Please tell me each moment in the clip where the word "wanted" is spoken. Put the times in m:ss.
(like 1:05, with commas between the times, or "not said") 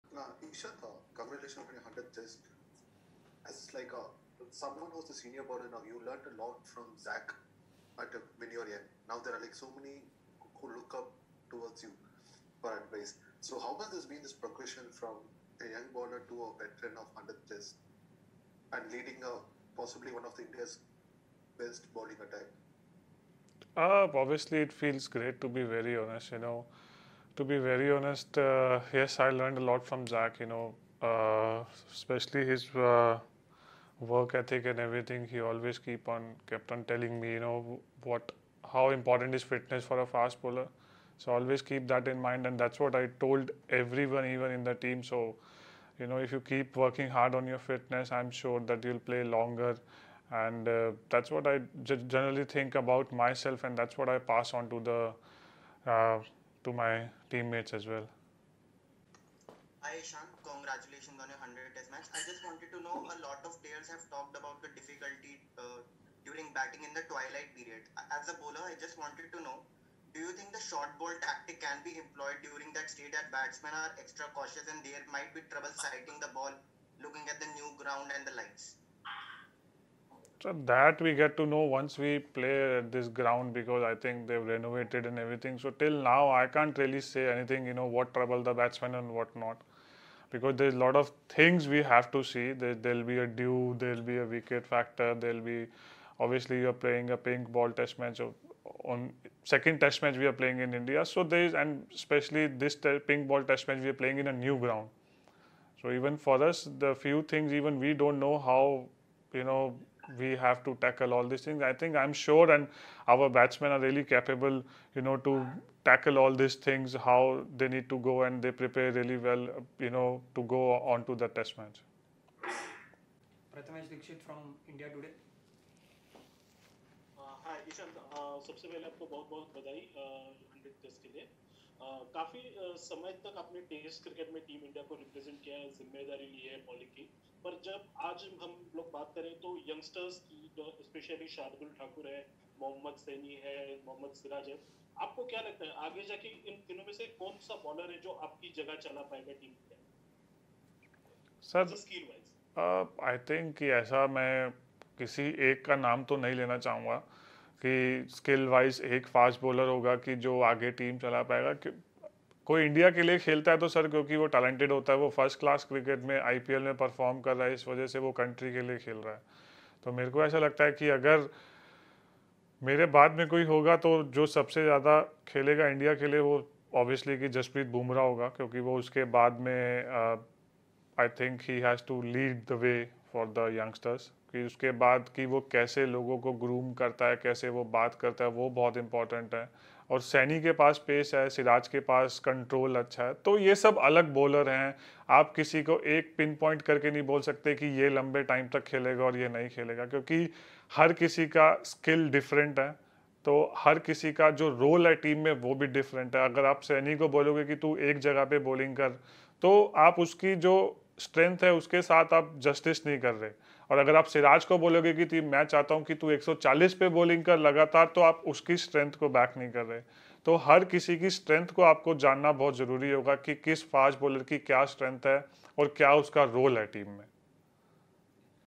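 1:02, 1:09.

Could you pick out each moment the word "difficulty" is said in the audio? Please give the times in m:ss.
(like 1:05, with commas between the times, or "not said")
1:04.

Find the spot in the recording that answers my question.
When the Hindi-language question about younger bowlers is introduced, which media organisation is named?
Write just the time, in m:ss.
2:04.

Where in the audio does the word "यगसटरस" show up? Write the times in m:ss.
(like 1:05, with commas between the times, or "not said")
2:19, 3:03.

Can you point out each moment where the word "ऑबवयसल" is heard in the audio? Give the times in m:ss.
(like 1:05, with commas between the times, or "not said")
2:56.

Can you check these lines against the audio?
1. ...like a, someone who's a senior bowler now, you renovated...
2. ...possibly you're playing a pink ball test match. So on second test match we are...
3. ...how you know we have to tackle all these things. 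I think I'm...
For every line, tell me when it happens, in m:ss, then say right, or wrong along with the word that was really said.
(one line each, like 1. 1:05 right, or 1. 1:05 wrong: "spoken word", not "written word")
1. 0:03 wrong: "learned", not "renovated"
2. 1:36 wrong: "obviously", not "possibly"
3. 1:48 right.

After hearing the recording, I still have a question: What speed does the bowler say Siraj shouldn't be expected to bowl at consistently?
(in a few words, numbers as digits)
140.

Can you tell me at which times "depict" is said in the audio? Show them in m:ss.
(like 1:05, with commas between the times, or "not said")
not said.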